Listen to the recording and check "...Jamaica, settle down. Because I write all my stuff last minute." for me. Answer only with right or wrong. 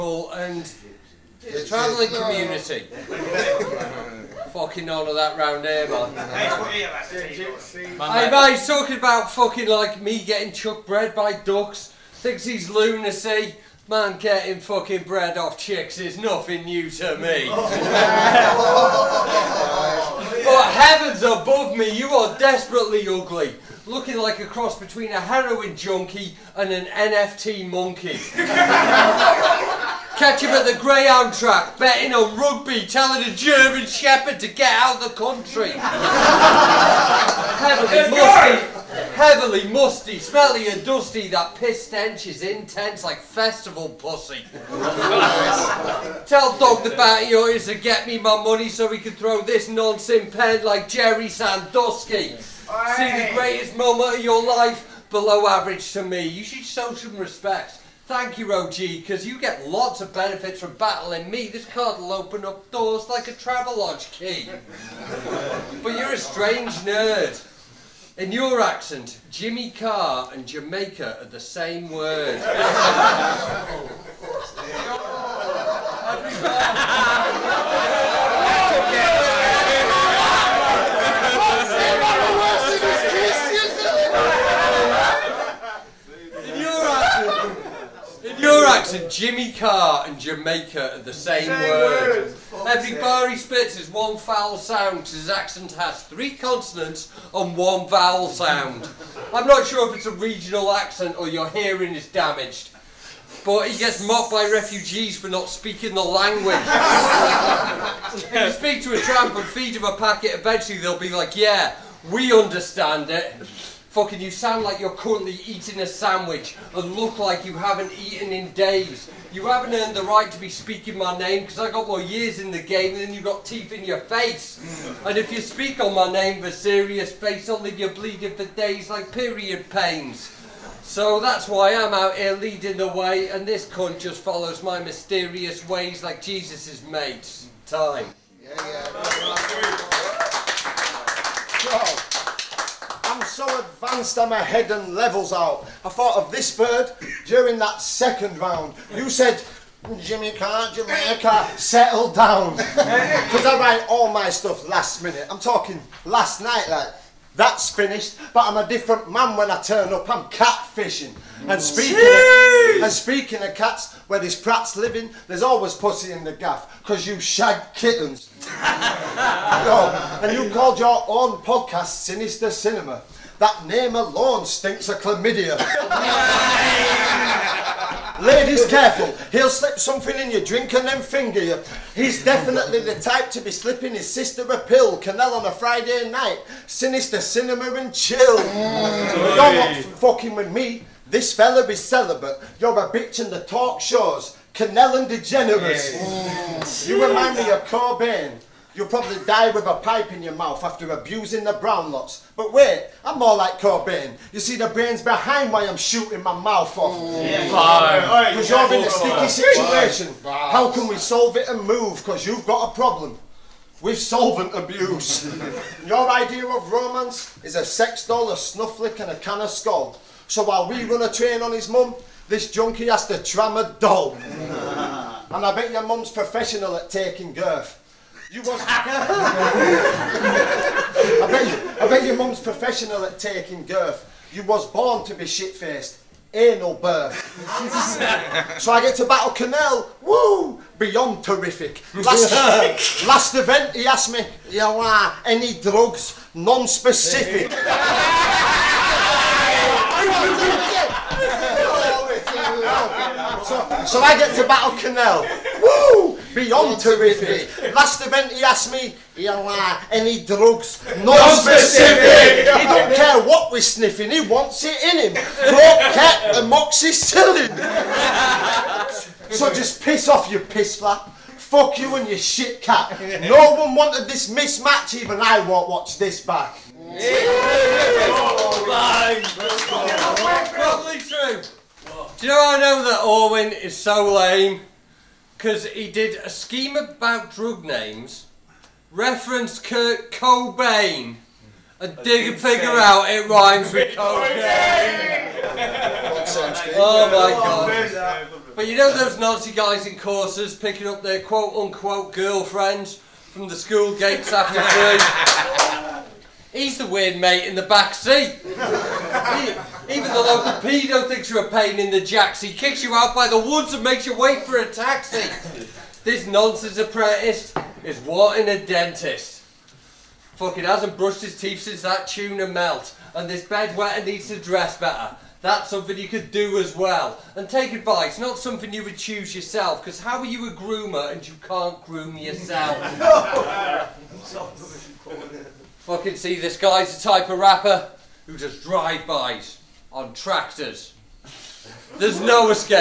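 right.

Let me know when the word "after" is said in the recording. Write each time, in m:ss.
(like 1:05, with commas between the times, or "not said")
3:20, 5:04.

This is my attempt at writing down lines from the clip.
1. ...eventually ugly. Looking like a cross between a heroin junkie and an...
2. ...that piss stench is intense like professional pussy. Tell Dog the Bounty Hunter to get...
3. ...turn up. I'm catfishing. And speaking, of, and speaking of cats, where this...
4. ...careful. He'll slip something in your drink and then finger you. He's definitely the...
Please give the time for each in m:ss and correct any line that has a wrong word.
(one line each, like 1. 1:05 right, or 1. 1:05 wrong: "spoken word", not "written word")
1. 0:22 wrong: "desperately", not "eventually"
2. 0:41 wrong: "festival", not "professional"
3. 2:39 right
4. 2:58 right.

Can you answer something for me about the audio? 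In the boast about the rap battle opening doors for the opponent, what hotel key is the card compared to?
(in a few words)
Travelodge key.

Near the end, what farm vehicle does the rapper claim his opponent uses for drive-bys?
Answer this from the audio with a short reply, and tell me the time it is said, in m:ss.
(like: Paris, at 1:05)
Tractors, at 5:40.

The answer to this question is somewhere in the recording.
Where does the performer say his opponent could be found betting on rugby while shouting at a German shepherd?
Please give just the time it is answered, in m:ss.
0:30.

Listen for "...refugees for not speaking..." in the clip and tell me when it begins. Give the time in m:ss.
1:44.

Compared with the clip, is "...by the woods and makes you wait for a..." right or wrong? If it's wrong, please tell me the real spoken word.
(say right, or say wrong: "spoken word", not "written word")
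right.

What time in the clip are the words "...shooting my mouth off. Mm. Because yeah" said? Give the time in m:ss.
3:25.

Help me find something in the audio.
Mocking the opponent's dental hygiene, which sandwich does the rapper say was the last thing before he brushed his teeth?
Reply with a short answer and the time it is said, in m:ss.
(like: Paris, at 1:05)
Tuna melt, at 5:22.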